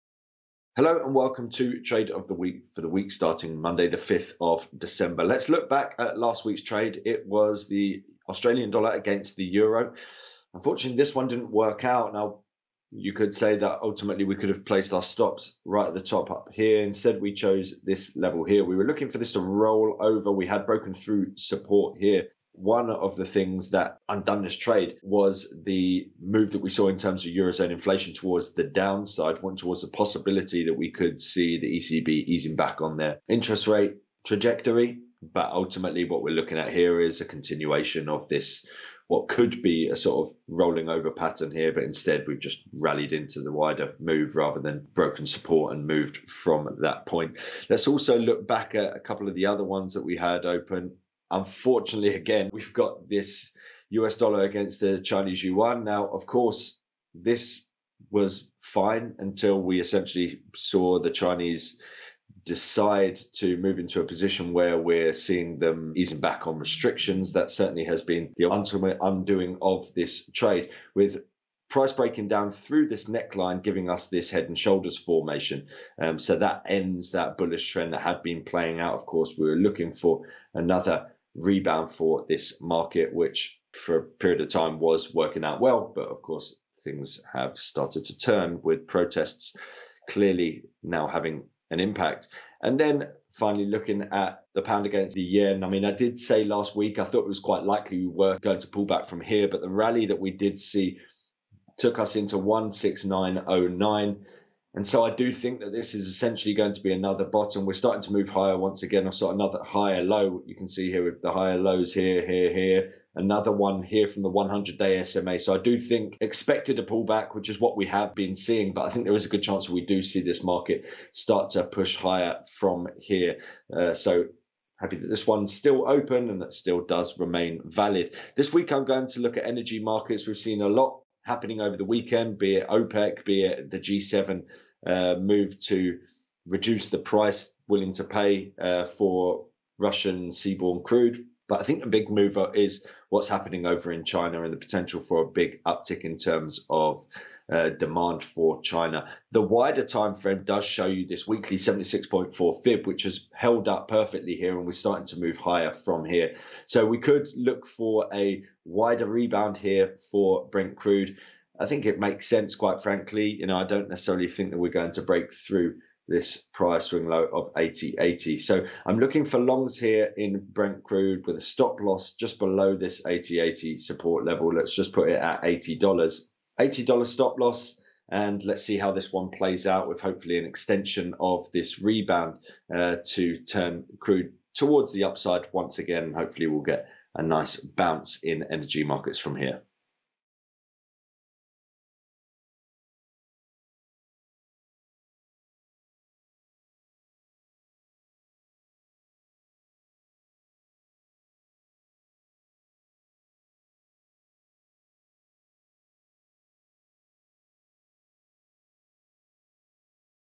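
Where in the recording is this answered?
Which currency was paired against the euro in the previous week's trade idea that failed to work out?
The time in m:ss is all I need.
0:08.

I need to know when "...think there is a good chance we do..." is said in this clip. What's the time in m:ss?
1:58.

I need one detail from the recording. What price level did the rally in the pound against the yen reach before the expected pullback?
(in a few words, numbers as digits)
16909.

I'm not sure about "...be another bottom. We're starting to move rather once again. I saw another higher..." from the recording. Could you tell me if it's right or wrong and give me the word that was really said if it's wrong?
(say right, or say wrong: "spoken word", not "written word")
wrong: "higher", not "rather".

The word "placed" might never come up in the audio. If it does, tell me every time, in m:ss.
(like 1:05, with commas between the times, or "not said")
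0:14.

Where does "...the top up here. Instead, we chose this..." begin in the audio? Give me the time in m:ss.
0:15.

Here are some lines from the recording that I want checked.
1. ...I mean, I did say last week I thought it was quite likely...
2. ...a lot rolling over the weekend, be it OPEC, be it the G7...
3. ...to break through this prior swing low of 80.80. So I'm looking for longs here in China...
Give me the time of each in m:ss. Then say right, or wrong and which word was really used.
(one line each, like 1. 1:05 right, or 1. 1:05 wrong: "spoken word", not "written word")
1. 1:35 right
2. 2:10 wrong: "happening", not "rolling"
3. 2:44 wrong: "Brent", not "China".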